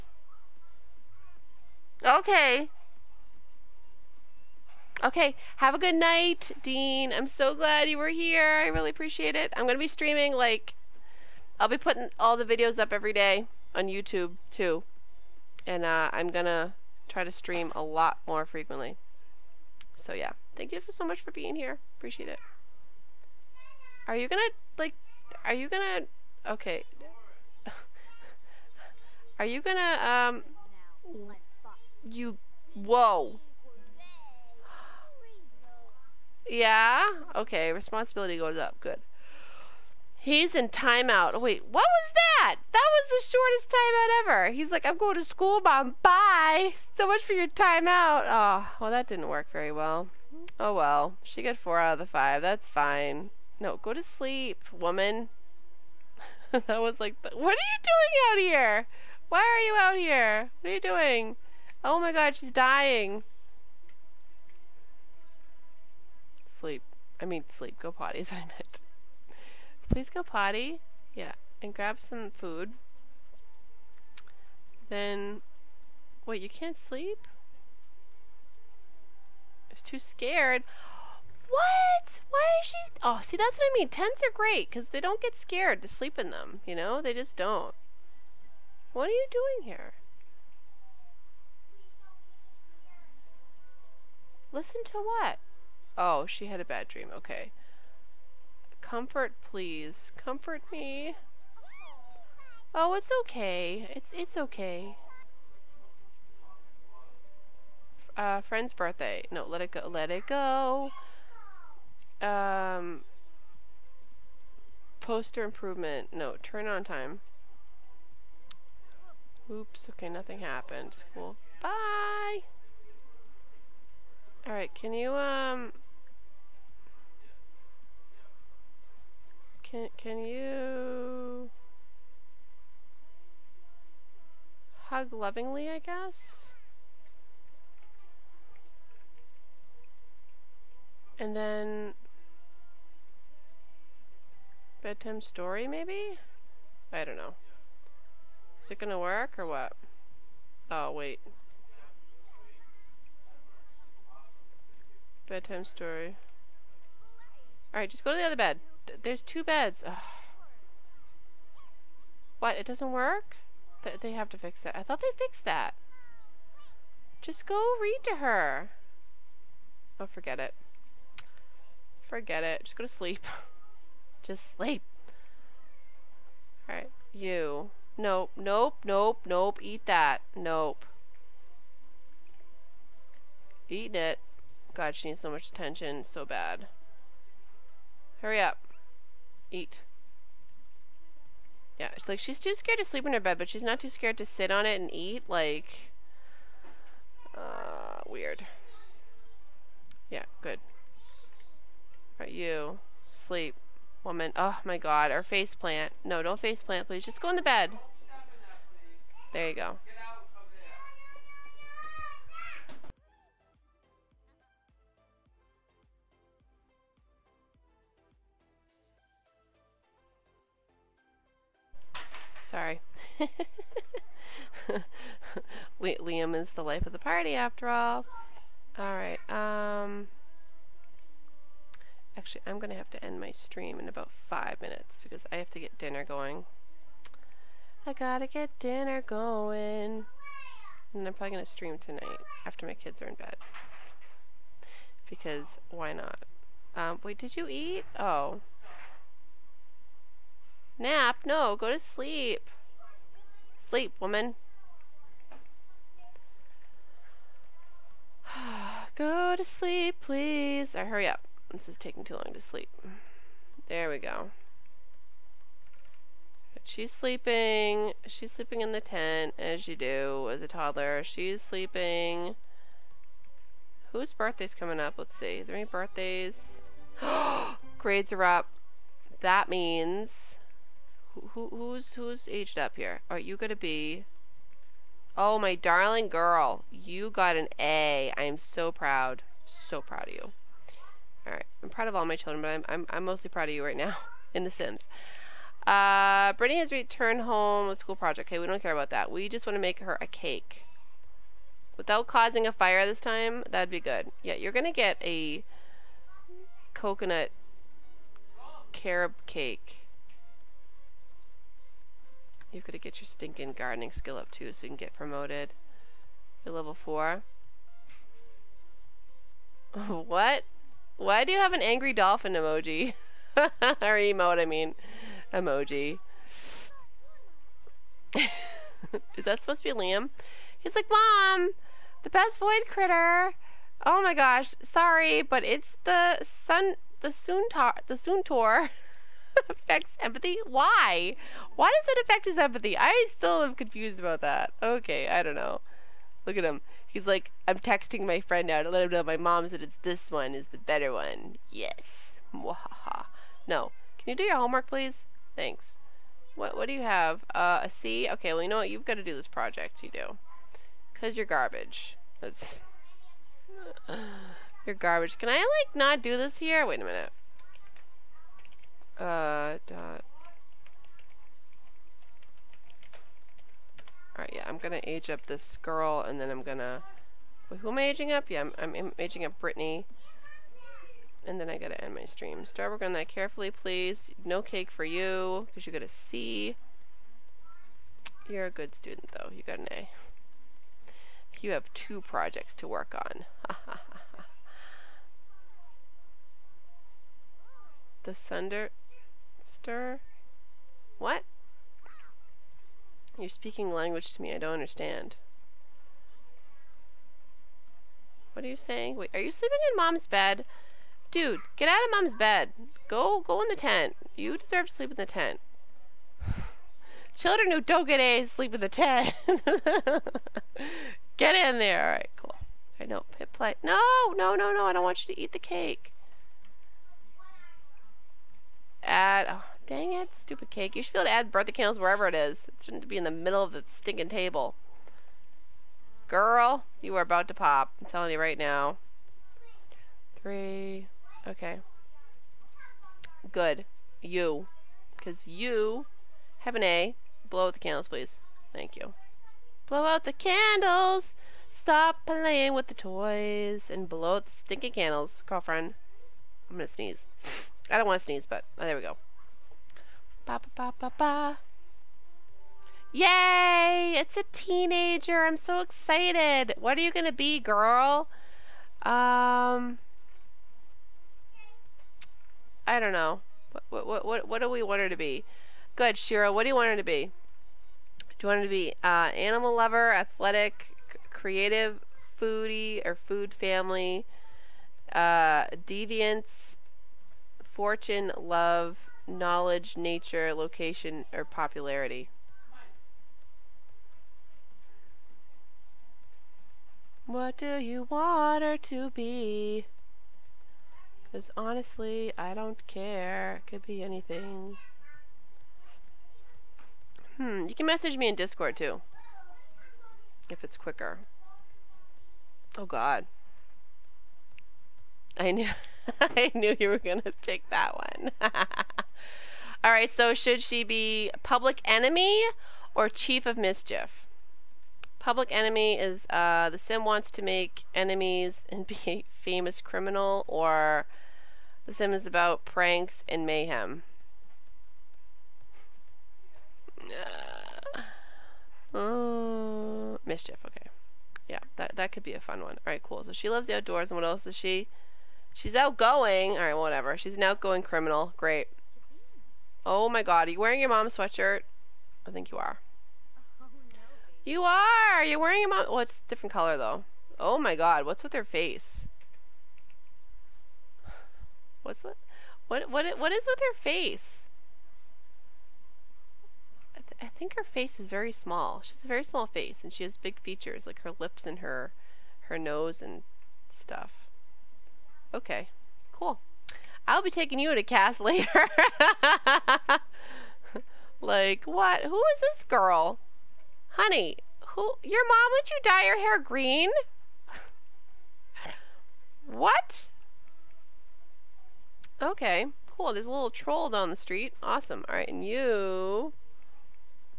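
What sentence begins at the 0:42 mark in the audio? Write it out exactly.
That was the shortest timeout ever.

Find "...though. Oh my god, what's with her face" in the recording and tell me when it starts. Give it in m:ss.
9:16.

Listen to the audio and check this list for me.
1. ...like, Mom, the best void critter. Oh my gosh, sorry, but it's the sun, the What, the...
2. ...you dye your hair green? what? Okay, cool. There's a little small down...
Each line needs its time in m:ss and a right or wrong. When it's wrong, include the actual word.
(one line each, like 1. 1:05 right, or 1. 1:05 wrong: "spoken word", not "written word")
1. 5:30 wrong: "Suntor", not "What"
2. 9:45 wrong: "troll", not "small".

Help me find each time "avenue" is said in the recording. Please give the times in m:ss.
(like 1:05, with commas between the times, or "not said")
not said.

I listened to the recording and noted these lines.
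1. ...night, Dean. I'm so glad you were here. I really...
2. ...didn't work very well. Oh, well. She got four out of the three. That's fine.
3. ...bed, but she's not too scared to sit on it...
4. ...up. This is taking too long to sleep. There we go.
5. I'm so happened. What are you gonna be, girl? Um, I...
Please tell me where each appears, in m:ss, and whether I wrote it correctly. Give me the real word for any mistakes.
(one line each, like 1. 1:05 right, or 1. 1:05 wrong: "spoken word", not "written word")
1. 0:05 right
2. 0:49 wrong: "five", not "three"
3. 3:13 right
4. 4:21 right
5. 7:45 wrong: "excited", not "happened".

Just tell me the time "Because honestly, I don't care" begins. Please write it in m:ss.
8:21.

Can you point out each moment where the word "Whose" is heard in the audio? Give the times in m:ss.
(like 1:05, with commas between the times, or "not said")
4:33.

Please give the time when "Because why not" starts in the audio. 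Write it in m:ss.
4:05.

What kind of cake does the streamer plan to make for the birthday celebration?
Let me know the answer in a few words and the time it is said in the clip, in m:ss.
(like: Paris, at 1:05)
coconut carob cake, at 5:06.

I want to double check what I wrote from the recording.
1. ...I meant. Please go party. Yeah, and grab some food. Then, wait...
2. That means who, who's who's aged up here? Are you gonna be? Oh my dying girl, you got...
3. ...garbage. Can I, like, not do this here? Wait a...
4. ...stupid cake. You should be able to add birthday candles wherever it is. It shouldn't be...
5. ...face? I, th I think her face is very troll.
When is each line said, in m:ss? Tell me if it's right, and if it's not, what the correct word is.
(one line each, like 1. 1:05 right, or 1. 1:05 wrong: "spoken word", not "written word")
1. 1:08 wrong: "potty", not "party"
2. 4:39 wrong: "darling", not "dying"
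3. 6:04 right
4. 7:10 right
5. 9:23 wrong: "small", not "troll".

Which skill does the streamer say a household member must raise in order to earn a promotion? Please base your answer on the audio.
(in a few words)
gardening.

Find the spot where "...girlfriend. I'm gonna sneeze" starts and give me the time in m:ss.
7:35.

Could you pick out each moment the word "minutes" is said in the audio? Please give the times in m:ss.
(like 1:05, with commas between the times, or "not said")
3:54, 6:06.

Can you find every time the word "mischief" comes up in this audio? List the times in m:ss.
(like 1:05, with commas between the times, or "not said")
8:43, 9:00.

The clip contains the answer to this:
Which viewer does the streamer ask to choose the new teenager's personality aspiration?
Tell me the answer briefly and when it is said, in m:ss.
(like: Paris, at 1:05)
Shira, at 7:55.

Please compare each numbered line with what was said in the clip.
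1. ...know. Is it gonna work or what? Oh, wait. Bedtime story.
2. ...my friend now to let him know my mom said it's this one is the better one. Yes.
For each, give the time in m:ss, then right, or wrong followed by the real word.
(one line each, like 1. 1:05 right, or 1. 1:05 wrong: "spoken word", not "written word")
1. 2:27 right
2. 5:48 right.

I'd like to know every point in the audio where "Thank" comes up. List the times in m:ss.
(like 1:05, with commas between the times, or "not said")
0:20, 5:55, 7:28.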